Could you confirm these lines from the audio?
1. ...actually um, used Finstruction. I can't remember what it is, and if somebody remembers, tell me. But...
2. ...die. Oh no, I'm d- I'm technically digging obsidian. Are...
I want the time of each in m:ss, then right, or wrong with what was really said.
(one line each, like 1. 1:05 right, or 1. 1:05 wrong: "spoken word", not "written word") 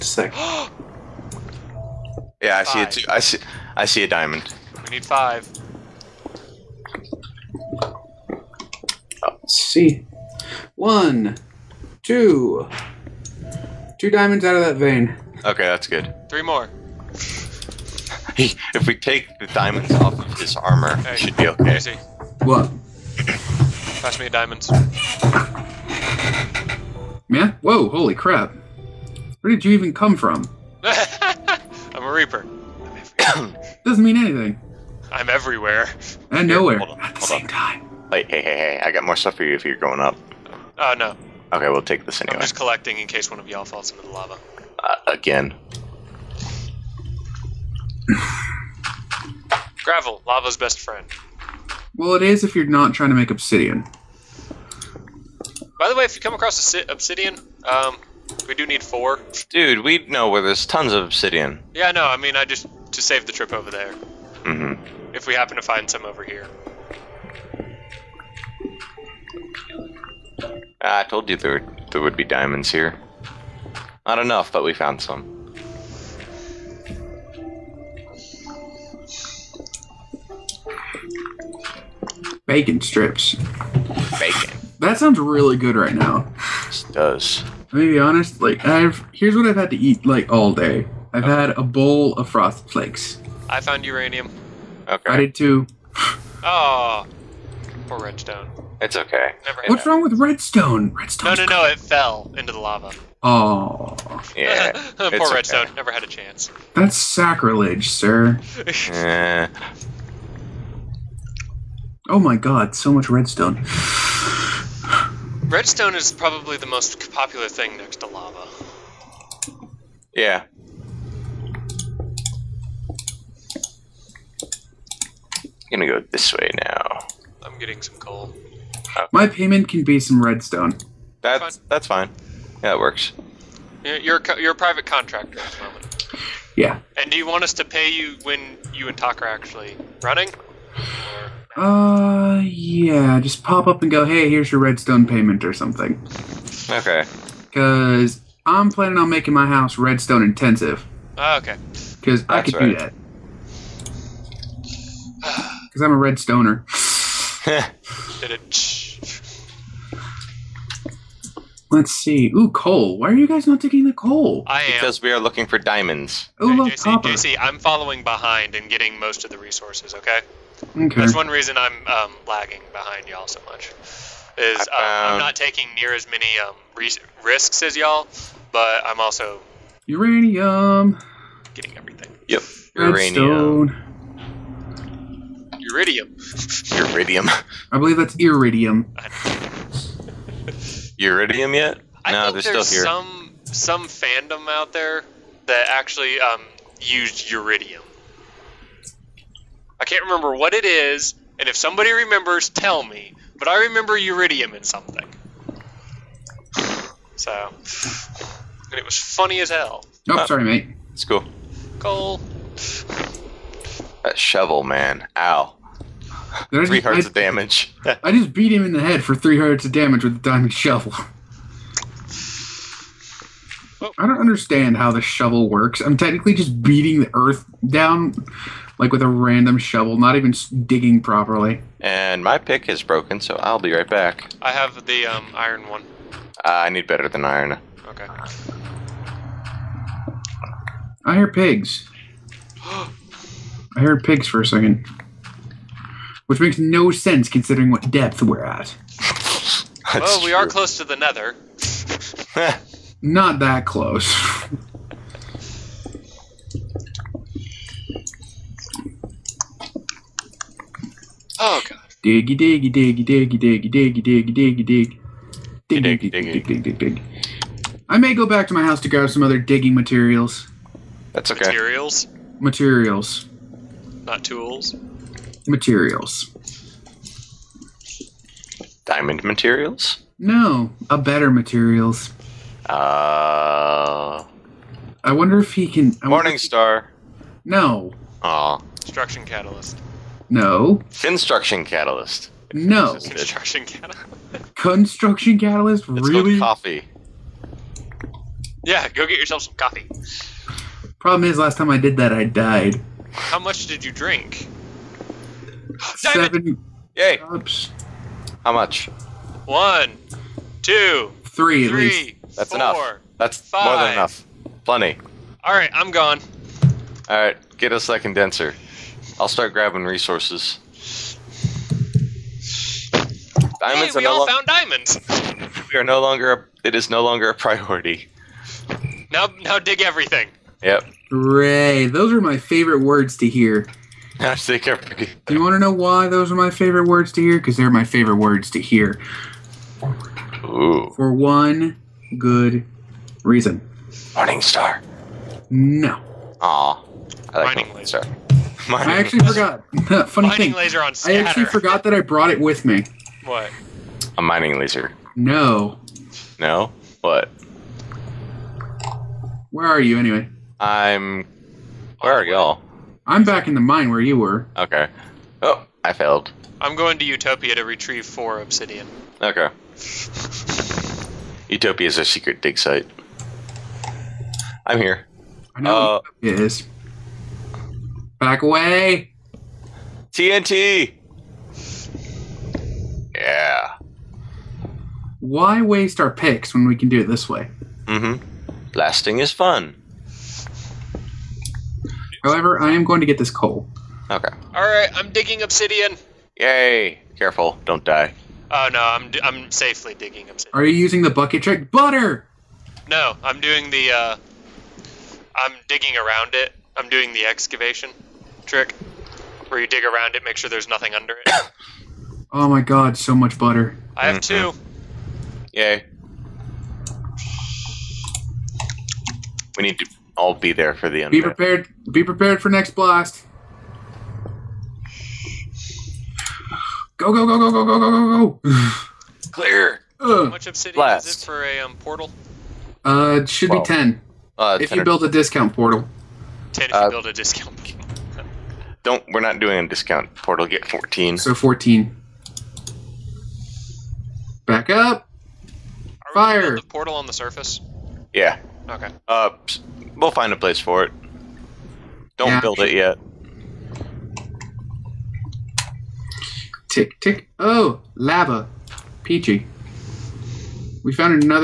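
1. 3:15 wrong: "Uridium", not "Finstruction"
2. 6:37 wrong: "safely", not "technically".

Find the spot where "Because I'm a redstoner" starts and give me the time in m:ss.
2:35.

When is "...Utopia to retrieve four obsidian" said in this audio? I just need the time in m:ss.
6:07.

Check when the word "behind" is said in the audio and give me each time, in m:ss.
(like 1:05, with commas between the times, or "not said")
2:48, 2:52.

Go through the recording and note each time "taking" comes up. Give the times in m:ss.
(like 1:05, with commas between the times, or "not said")
2:43, 2:55.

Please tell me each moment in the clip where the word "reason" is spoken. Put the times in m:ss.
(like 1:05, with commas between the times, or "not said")
2:51, 5:43.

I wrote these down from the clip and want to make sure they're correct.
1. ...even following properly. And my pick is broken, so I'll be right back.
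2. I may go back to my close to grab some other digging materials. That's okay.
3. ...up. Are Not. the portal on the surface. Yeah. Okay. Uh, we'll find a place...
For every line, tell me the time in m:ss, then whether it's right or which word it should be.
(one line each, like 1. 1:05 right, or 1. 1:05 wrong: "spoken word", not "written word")
1. 3:50 wrong: "digging", not "following"
2. 4:27 wrong: "house", not "close"
3. 7:24 wrong: "Fire", not "Not".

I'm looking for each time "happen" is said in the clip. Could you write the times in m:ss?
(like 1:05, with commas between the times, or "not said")
1:05.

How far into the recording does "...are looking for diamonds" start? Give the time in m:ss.
2:45.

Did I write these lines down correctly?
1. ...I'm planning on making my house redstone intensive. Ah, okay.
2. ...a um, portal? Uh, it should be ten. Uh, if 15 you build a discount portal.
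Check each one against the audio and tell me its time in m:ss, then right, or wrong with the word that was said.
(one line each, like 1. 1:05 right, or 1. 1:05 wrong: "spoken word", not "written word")
1. 2:28 right
2. 7:11 wrong: "10", not "15".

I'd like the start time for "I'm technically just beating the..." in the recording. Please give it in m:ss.
3:45.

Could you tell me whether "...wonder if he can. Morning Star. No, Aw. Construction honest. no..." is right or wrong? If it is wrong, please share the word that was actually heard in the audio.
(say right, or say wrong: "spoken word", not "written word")
wrong: "catalyst", not "honest".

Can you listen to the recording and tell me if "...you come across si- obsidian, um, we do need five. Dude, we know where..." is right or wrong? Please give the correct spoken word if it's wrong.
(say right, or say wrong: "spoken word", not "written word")
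wrong: "four", not "five".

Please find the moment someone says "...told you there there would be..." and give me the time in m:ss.
1:11.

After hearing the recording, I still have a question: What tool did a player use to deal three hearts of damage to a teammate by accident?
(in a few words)
Diamond shovel.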